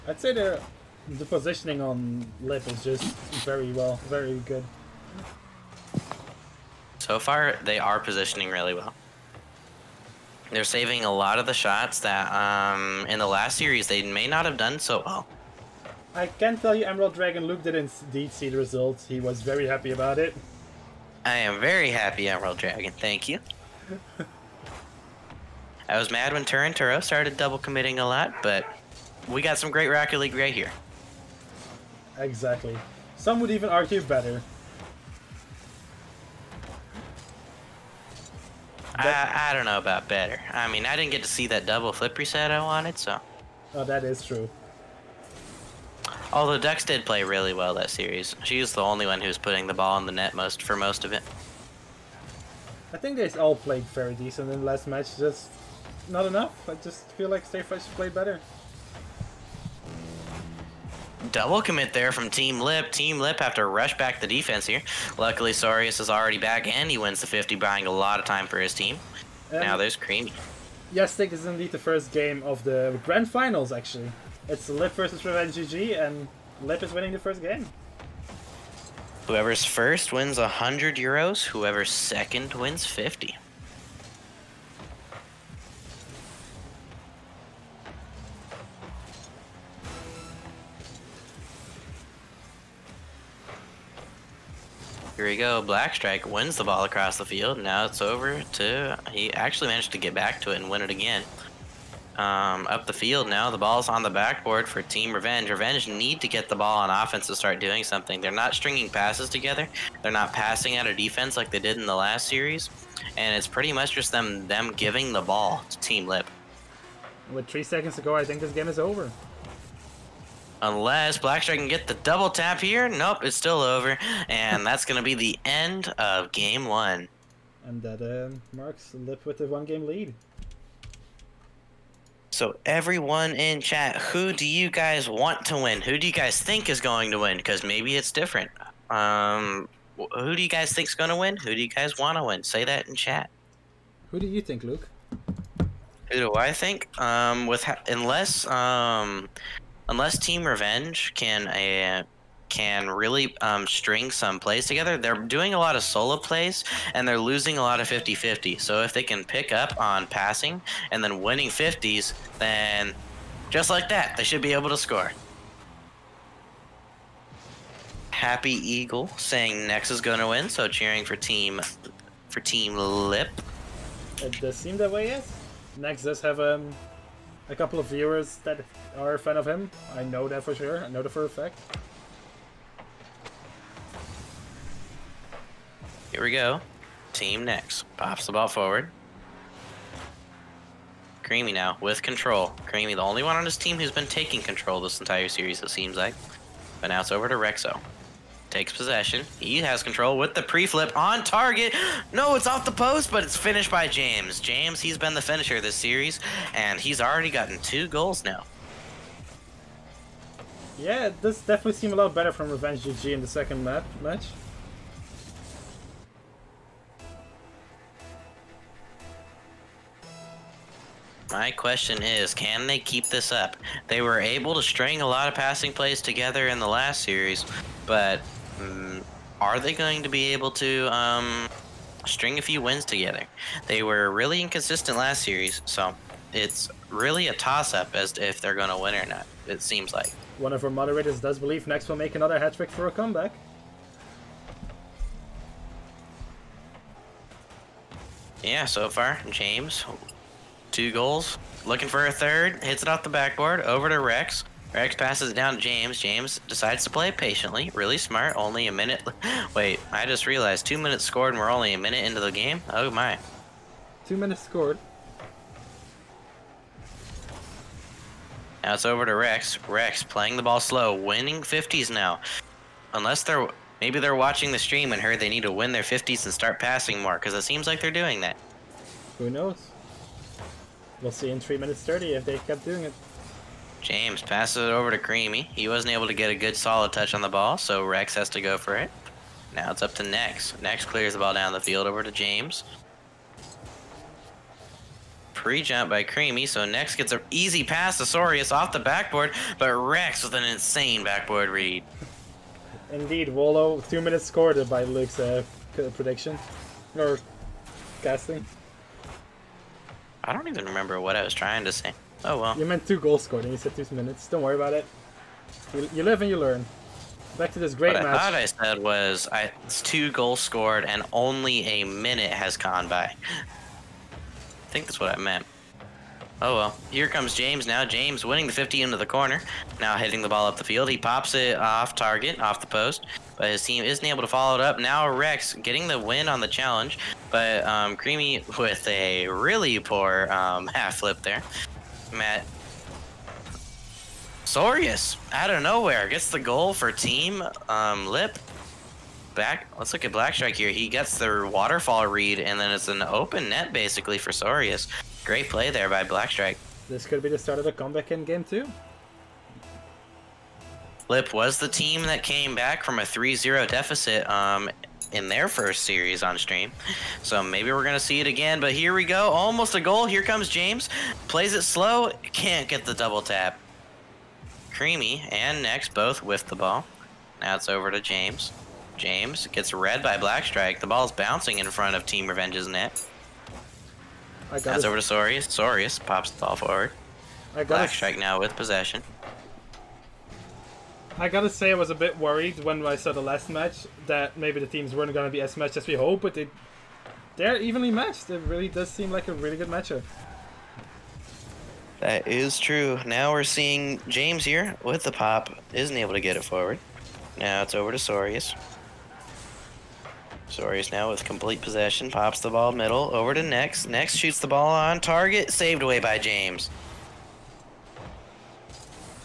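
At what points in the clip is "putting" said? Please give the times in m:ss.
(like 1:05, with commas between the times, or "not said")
0:49.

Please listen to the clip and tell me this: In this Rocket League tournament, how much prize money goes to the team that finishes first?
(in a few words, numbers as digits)
100 euros.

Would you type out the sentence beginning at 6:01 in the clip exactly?
Lip was the team that came back from a 3-0 deficit um, in their first series on stream.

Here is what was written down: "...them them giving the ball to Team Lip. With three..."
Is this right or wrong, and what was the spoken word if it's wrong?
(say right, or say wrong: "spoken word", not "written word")
right.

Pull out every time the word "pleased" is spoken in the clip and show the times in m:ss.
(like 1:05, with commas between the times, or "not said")
not said.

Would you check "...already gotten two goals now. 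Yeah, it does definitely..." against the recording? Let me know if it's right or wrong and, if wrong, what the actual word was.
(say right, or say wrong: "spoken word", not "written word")
right.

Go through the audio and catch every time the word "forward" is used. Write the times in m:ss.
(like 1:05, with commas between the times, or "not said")
3:08, 6:26, 6:46.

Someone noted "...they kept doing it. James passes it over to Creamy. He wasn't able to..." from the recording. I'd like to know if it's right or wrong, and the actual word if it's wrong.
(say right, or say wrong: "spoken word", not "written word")
right.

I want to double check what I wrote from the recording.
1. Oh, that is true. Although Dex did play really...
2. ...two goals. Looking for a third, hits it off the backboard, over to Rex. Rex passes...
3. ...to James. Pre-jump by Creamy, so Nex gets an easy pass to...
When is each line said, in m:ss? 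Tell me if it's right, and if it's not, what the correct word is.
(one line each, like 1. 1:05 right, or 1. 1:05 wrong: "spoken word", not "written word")
1. 0:43 right
2. 4:10 right
3. 4:52 right.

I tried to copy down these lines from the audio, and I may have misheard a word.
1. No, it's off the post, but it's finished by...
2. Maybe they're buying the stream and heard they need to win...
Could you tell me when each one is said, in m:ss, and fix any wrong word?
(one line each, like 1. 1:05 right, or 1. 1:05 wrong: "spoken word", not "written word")
1. 3:22 right
2. 4:33 wrong: "watching", not "buying".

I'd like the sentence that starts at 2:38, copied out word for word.
So if they can pick up on passing and then winning 50s, then just like that, they should be able to score.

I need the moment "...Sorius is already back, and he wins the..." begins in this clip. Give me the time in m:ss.
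1:05.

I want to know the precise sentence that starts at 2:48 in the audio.
Happy Eagle saying Nex is going to win, so cheering for team for team Lip.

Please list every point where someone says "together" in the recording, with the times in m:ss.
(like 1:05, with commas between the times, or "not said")
1:49, 2:34, 3:46, 3:52.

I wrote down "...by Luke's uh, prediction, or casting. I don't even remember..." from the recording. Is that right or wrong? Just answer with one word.
right.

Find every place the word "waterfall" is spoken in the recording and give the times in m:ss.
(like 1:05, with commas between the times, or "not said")
5:51.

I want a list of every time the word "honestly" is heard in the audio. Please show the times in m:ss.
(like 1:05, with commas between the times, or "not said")
not said.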